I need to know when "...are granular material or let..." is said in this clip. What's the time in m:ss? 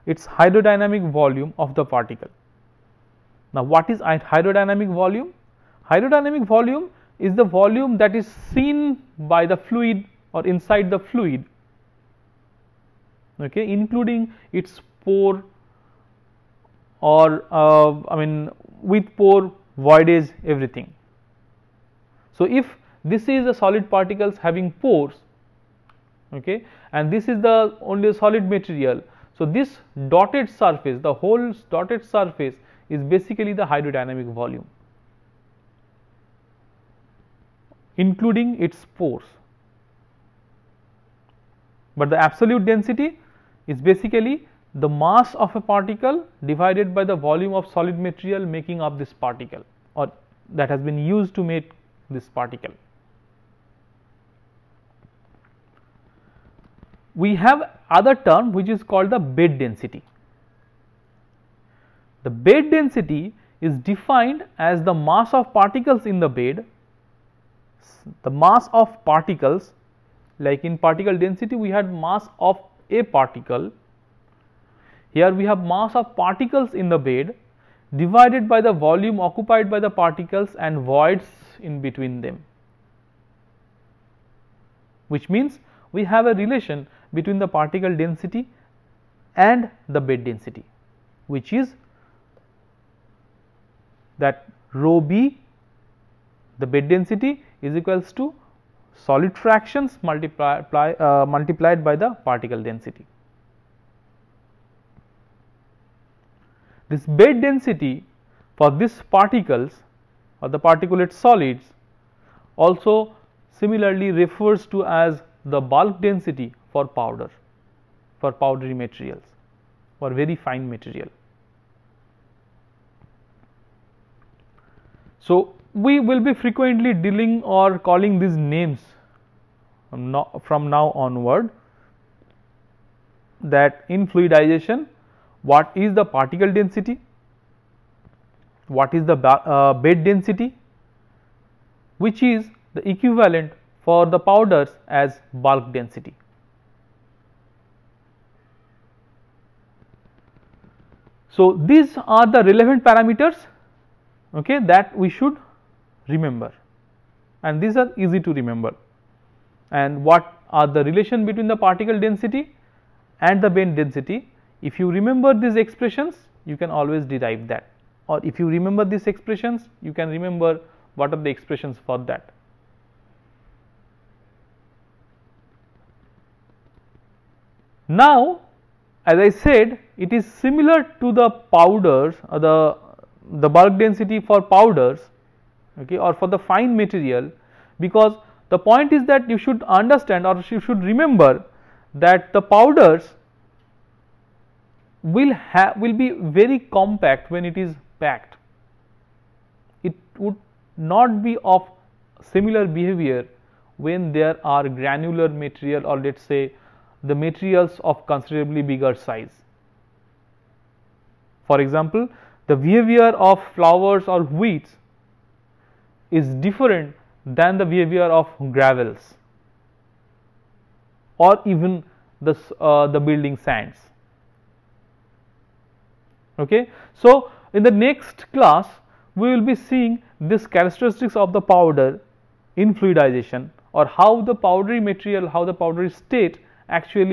3:24.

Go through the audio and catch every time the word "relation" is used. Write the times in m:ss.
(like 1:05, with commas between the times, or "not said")
1:26, 2:40.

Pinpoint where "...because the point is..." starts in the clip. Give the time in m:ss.
3:07.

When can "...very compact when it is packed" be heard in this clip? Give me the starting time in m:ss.
3:16.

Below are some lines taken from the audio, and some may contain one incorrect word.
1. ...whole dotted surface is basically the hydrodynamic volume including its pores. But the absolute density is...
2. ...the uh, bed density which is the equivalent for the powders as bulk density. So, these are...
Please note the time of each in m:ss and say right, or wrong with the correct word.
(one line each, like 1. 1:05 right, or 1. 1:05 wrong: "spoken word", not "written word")
1. 0:31 right
2. 2:19 right.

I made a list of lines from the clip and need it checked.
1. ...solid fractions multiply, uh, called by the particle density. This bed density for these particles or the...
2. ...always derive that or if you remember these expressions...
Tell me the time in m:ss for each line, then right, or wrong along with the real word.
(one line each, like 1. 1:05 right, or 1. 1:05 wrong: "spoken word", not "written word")
1. 1:39 wrong: "multiplied", not "called"
2. 2:46 right.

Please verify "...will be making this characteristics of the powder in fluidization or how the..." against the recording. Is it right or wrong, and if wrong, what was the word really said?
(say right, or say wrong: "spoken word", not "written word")
wrong: "seeing", not "making".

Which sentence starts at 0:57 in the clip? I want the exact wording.
we have other term which is called the bed density.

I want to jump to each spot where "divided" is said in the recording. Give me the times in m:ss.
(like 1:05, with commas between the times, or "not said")
0:46, 1:17.